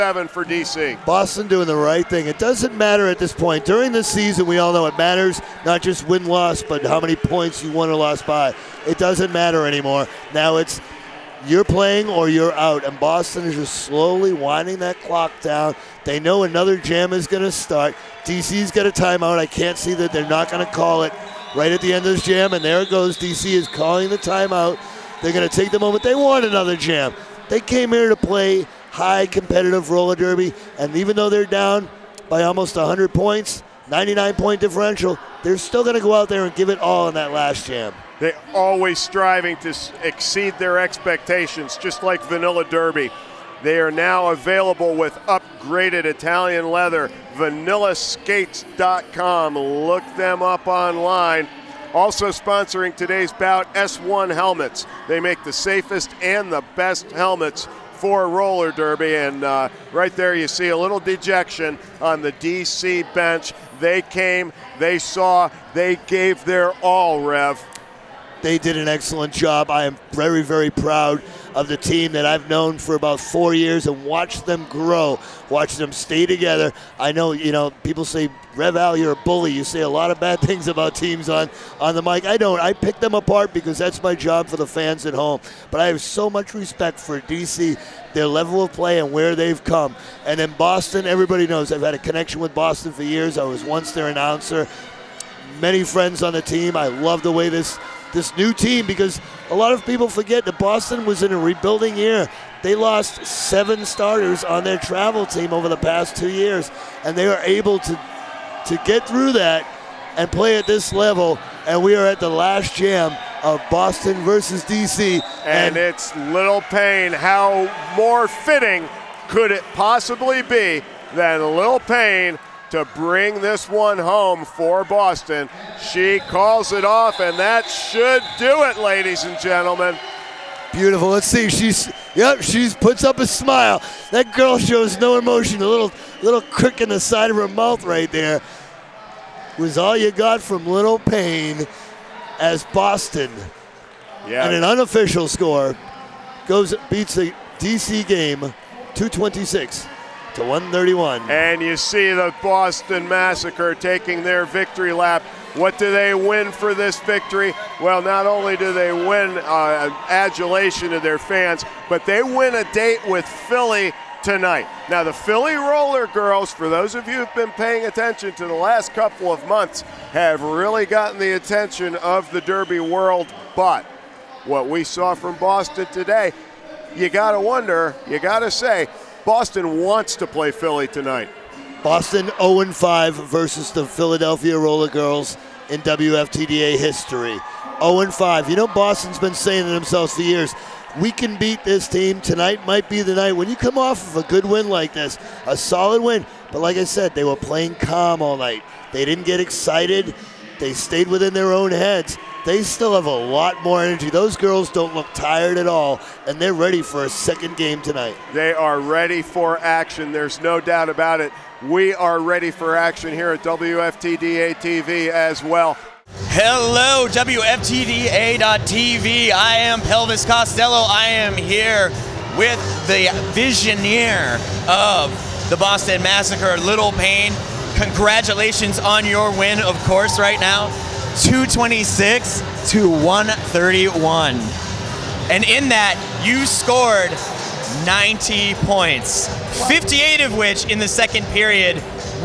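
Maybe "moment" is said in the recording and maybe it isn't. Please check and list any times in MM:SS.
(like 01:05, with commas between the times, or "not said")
00:25.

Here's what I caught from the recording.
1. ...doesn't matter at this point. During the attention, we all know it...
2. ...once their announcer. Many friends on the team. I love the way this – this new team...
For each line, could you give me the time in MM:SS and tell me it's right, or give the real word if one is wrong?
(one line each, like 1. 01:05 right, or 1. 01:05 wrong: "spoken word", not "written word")
1. 00:02 wrong: "season", not "attention"
2. 01:33 right.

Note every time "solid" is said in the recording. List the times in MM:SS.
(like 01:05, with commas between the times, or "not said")
03:15.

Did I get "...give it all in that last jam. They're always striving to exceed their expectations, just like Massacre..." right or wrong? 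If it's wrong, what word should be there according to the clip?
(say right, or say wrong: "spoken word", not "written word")
wrong: "Vanilla", not "Massacre".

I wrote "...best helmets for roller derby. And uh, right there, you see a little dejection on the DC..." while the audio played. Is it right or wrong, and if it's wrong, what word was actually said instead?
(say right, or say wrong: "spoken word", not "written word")
right.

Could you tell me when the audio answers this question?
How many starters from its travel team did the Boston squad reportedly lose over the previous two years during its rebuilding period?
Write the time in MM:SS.
01:43.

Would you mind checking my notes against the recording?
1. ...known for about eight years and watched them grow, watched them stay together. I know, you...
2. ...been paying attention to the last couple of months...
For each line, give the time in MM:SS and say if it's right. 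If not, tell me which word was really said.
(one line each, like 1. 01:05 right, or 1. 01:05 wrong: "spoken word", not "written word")
1. 01:12 wrong: "four", not "eight"
2. 02:47 right.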